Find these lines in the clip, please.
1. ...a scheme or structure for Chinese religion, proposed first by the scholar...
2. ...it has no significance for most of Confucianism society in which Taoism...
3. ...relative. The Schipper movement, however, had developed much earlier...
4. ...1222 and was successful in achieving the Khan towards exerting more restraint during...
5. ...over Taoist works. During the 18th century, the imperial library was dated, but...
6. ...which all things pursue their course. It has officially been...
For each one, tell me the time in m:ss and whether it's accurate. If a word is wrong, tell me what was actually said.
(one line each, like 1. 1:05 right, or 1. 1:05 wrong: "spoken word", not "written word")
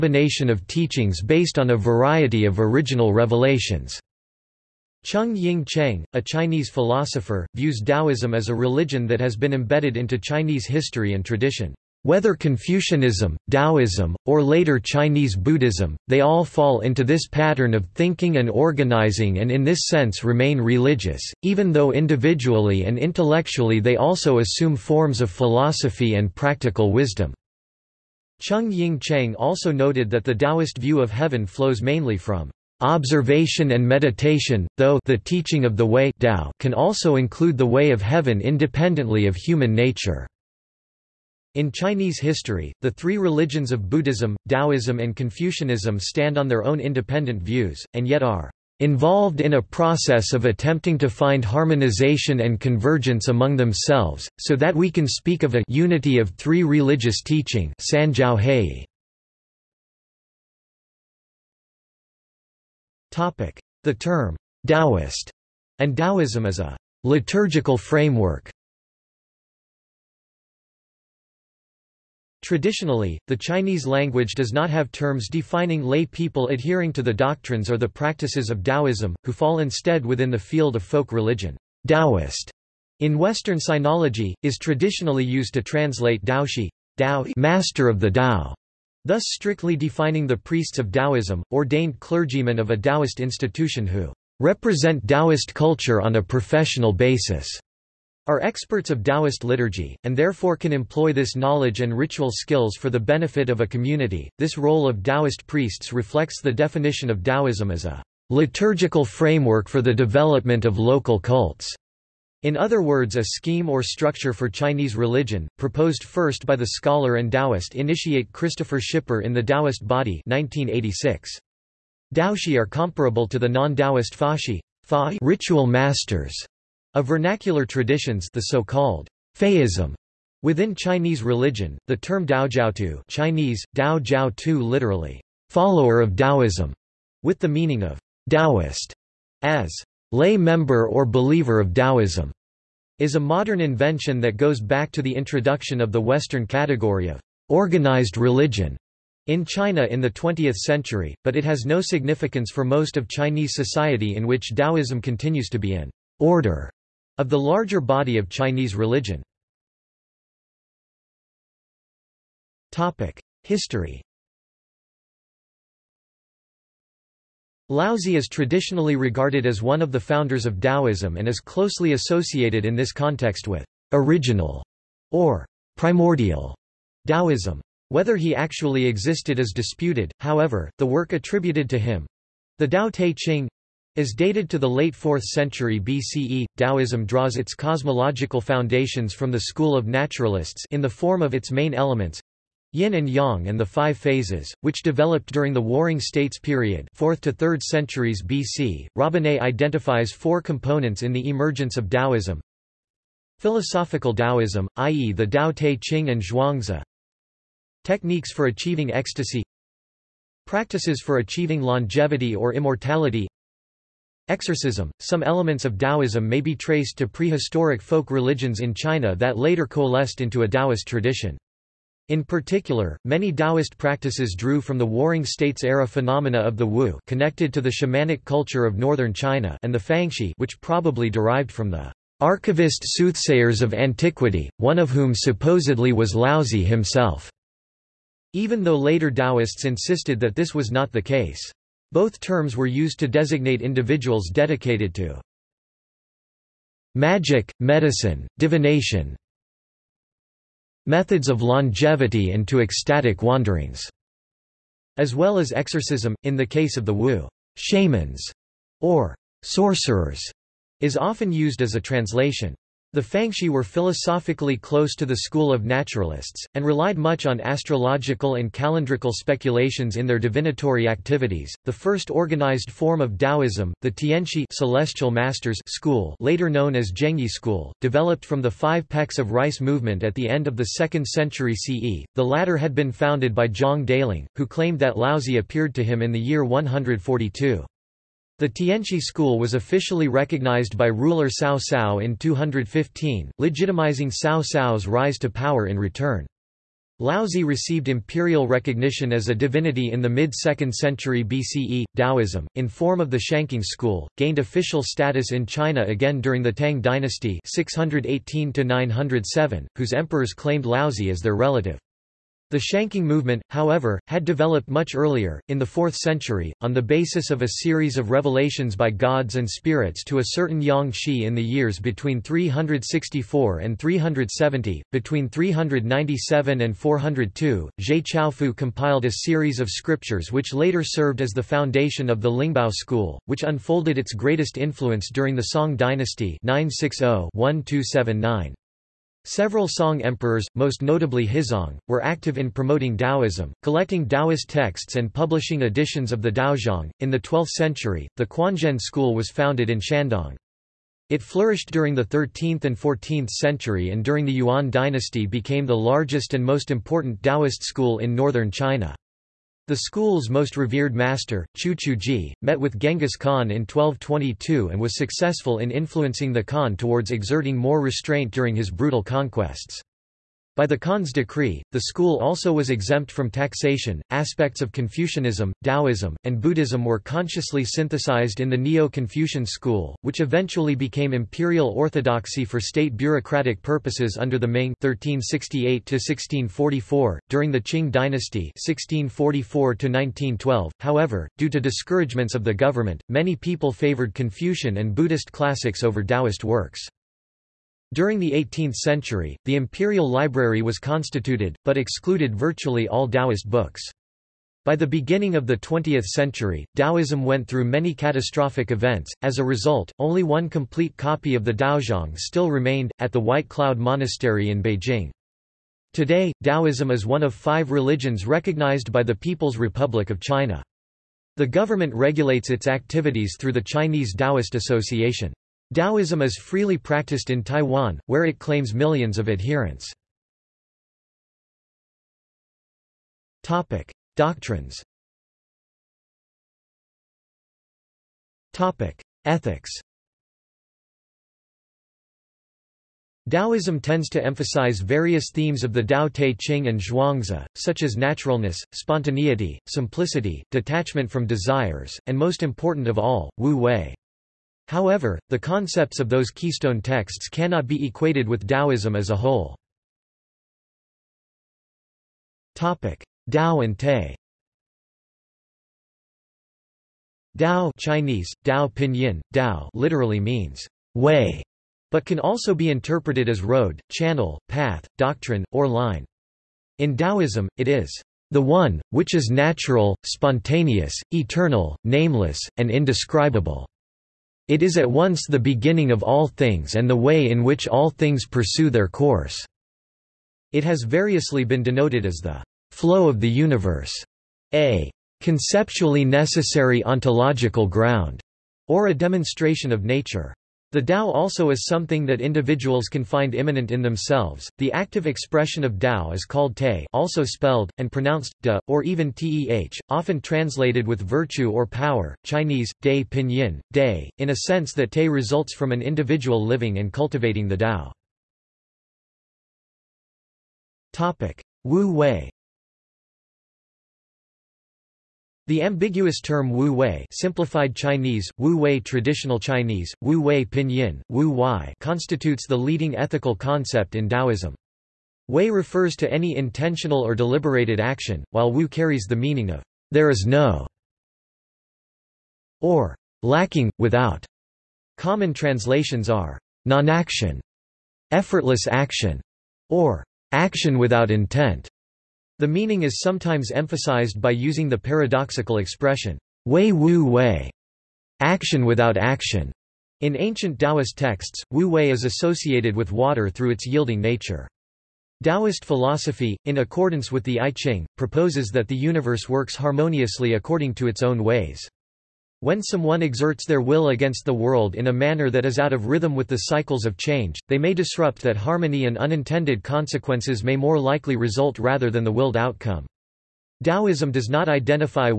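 1. 1:53 right
2. 2:31 wrong: "Chinese", not "Confucianism"
3. 5:11 wrong: "Shangqing", not "Schipper"
4. 6:03 wrong: "influencing", not "achieving"
5. 6:35 wrong: "constituted", not "dated"
6. 8:07 wrong: "variously", not "officially".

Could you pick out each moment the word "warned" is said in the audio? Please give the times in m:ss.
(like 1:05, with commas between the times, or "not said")
not said.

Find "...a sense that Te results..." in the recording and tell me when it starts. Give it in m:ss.
8:34.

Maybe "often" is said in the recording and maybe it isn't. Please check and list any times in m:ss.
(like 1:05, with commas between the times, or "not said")
4:20, 8:29.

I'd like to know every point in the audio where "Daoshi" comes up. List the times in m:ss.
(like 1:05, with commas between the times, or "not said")
1:26, 2:02.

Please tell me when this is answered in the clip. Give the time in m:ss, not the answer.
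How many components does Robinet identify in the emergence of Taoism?
3:20.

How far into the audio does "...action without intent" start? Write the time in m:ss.
9:10.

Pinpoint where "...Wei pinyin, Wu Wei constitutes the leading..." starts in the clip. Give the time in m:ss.
8:50.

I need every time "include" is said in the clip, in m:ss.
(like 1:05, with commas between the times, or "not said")
0:37.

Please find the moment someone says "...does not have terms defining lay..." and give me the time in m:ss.
1:14.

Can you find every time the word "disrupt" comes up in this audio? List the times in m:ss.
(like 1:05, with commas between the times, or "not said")
9:37.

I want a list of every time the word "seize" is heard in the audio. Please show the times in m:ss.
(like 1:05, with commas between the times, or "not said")
not said.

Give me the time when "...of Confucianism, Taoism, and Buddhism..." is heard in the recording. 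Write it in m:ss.
6:14.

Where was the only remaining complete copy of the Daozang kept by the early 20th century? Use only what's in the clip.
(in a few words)
White Cloud Monastery.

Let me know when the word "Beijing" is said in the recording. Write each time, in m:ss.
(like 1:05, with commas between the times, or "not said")
6:54.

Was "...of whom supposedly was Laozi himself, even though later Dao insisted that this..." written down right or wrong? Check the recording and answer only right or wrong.
wrong.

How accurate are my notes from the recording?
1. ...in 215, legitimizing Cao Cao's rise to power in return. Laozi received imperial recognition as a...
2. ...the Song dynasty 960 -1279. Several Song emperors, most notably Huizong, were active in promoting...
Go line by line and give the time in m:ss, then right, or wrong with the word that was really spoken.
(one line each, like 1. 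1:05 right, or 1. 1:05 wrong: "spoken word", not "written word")
1. 4:52 right
2. 5:35 right.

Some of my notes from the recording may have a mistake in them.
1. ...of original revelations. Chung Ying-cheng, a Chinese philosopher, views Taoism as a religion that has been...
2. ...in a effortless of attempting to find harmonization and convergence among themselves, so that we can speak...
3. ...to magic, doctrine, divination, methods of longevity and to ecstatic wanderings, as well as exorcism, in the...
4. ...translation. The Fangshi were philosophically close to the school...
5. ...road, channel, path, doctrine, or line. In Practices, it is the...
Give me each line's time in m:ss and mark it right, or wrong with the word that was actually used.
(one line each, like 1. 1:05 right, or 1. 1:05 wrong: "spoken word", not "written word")
1. 0:02 right
2. 0:49 wrong: "process", not "effortless"
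3. 4:04 wrong: "medicine", not "doctrine"
4. 4:21 right
5. 7:53 wrong: "Taoism", not "Practices".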